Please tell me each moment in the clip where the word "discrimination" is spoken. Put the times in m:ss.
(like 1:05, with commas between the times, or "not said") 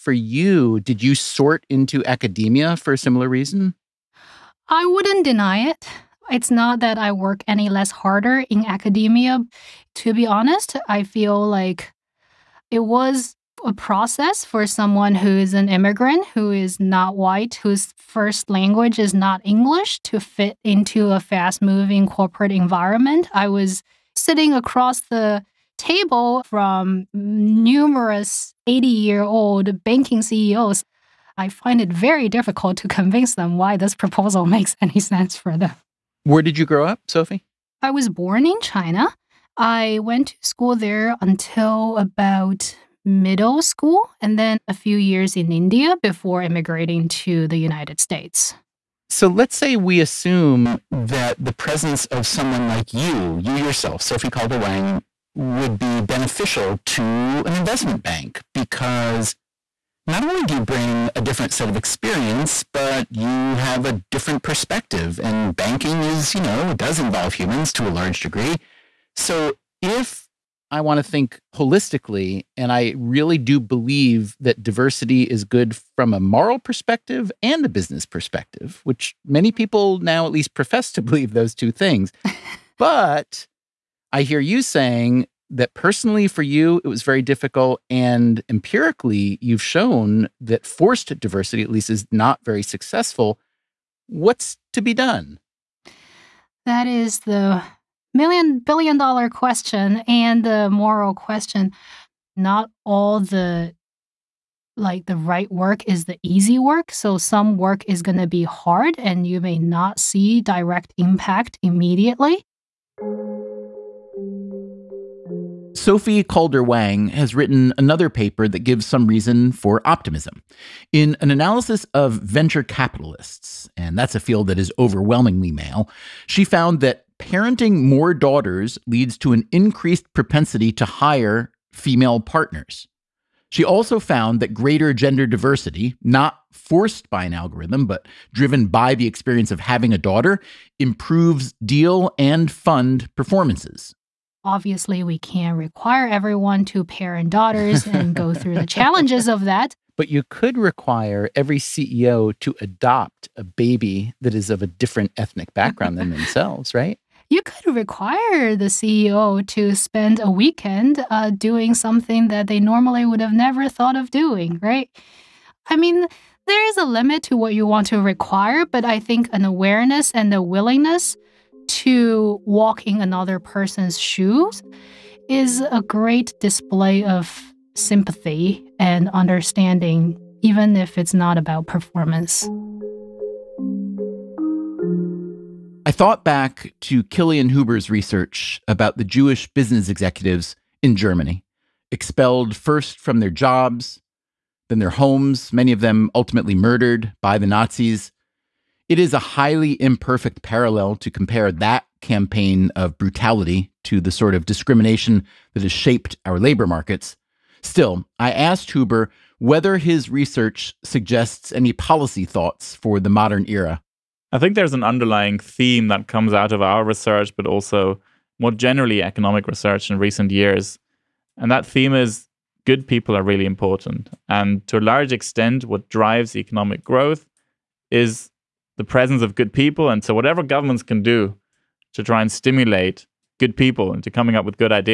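3:24.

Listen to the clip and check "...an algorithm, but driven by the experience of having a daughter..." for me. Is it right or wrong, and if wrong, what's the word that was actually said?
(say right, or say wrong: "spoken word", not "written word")
right.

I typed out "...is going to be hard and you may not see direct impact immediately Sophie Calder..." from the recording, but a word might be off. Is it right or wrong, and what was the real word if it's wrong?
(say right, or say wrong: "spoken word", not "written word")
right.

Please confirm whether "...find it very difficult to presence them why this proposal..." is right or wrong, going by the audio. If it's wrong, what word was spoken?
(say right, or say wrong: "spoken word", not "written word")
wrong: "convince", not "presence".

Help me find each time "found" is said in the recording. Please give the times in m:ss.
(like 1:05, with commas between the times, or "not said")
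2:06, 2:13.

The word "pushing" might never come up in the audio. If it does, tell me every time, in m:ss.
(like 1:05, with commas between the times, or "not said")
not said.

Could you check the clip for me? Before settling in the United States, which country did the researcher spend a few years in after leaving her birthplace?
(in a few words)
India.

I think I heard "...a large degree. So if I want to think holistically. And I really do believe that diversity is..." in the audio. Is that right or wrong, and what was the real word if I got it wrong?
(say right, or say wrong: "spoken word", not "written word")
right.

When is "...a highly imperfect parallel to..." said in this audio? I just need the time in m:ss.
3:19.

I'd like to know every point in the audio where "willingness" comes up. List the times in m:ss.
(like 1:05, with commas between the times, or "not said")
2:50.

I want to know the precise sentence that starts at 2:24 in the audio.
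Obviously, we can't require everyone to parent daughters and go through the challenges of that.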